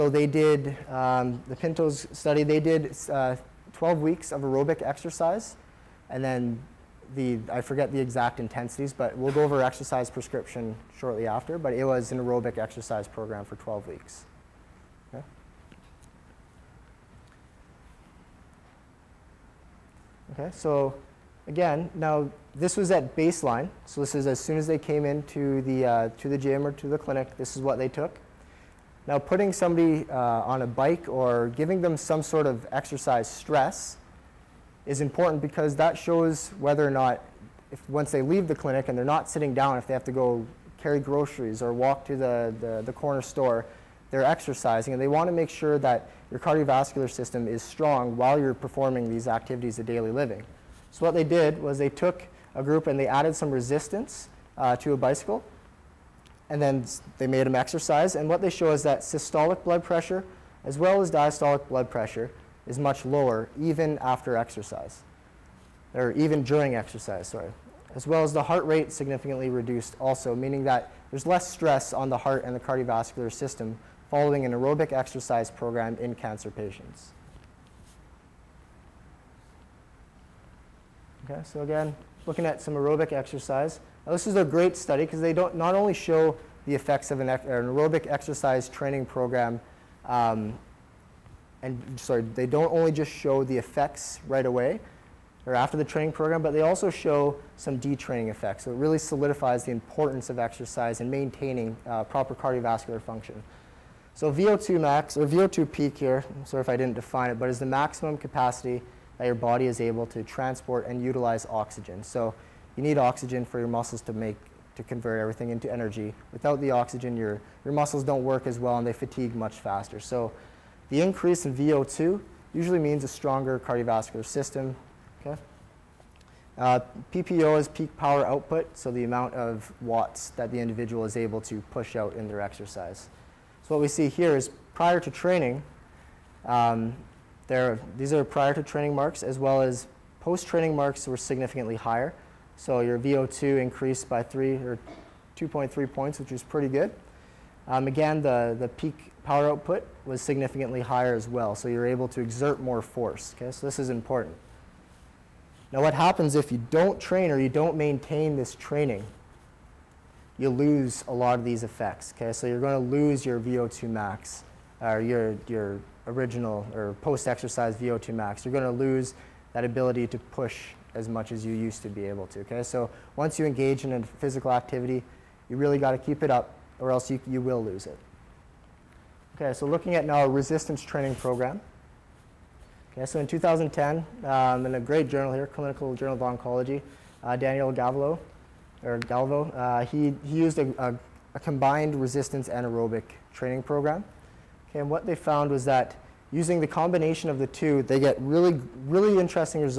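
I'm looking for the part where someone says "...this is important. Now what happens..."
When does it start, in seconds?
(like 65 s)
153 s.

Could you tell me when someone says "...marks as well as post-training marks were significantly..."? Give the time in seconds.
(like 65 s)
138 s.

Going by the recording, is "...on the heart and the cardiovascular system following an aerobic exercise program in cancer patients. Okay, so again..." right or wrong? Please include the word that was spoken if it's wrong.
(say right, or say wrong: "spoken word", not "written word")
right.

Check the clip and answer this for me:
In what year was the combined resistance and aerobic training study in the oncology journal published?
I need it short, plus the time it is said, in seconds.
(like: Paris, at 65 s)
2010, at 183 s.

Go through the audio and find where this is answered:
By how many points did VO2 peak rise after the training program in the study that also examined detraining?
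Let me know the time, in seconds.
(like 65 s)
145 s.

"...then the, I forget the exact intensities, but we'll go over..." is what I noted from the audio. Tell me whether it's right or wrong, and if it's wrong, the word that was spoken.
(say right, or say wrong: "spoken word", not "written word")
right.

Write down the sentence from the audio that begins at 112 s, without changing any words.
So you need oxygen for your muscles to make, to convert everything into energy.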